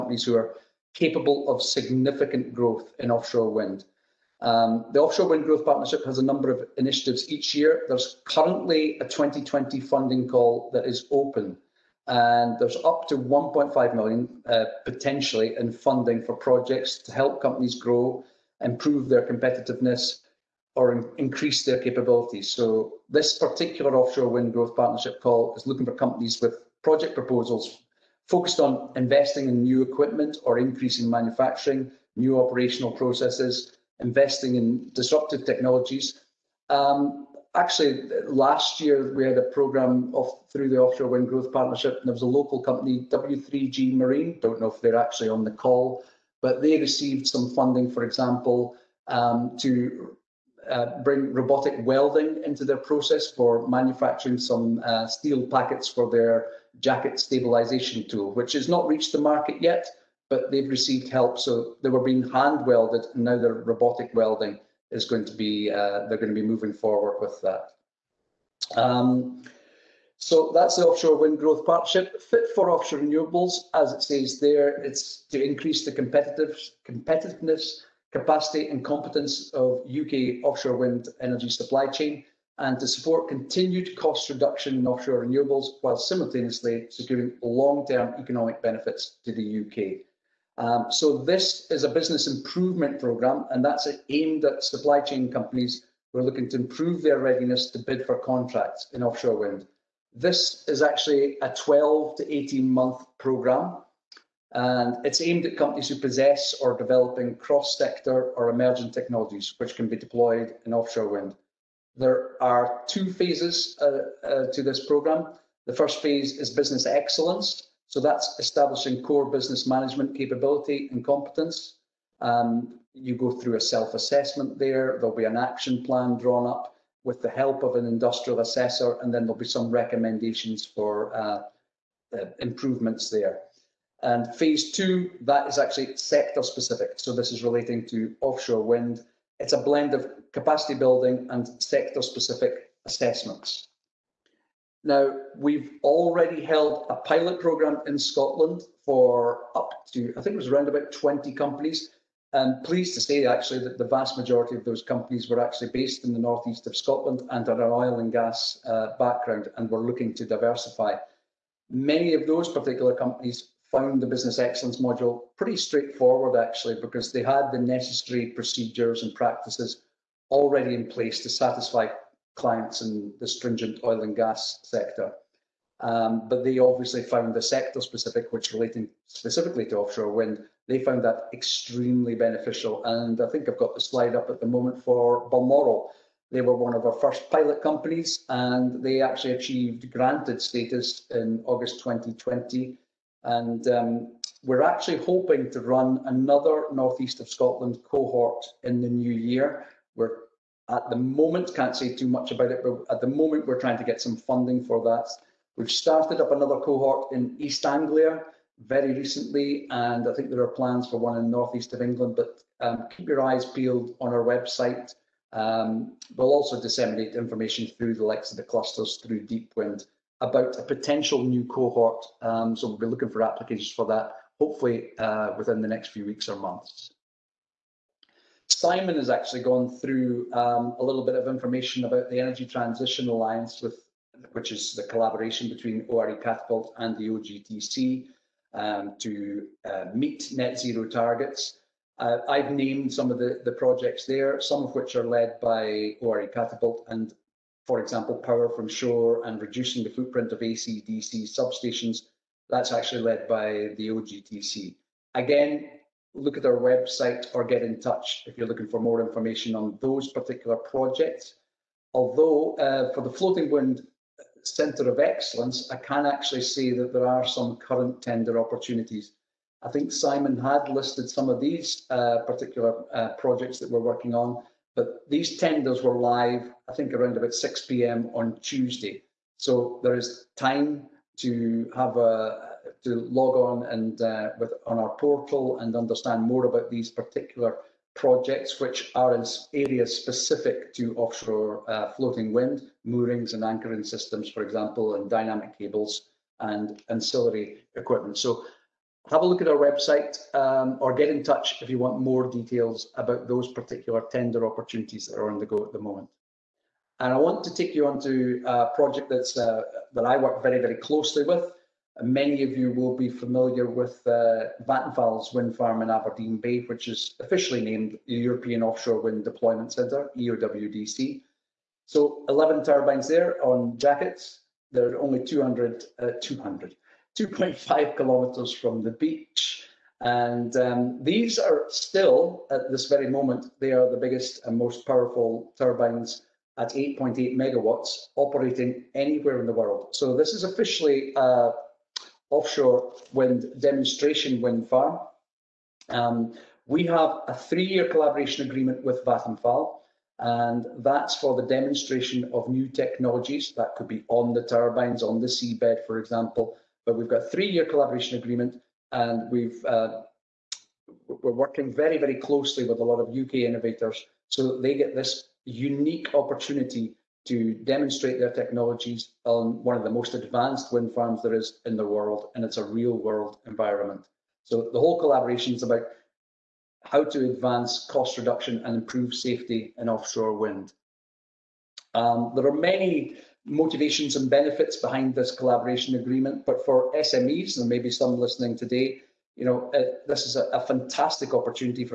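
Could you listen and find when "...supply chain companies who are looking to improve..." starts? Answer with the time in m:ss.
1:34.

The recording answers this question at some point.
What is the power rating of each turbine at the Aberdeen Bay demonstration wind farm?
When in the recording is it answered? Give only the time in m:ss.
5:36.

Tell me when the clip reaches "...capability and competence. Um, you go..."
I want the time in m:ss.
2:00.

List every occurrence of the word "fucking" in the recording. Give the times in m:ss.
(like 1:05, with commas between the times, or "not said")
not said.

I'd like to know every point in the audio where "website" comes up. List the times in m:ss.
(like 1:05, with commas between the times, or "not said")
3:34, 4:16, 4:59.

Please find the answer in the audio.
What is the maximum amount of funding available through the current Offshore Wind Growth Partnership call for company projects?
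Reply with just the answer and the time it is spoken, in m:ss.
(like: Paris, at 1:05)
1.5 million, at 0:13.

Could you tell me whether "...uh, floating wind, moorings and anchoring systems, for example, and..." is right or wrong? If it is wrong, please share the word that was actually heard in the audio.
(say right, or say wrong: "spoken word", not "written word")
right.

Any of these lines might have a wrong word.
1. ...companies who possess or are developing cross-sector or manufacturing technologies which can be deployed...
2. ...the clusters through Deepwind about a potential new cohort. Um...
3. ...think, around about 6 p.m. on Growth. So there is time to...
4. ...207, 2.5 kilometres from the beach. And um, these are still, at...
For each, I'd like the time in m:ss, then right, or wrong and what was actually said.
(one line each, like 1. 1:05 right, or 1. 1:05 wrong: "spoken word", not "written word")
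1. 1:45 wrong: "emerging", not "manufacturing"
2. 3:38 right
3. 4:36 wrong: "Tuesday", not "Growth"
4. 5:26 wrong: "200", not "207".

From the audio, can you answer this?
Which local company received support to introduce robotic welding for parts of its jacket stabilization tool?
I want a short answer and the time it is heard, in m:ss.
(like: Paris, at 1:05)
W3G Marine, at 0:43.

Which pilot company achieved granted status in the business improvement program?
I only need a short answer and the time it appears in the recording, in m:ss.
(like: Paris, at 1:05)
Balmoral, at 3:05.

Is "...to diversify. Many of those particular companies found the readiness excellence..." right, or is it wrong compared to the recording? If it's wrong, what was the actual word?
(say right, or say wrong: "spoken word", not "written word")
wrong: "business", not "readiness".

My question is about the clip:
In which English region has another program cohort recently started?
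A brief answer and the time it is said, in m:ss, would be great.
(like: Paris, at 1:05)
East Anglia, at 3:27.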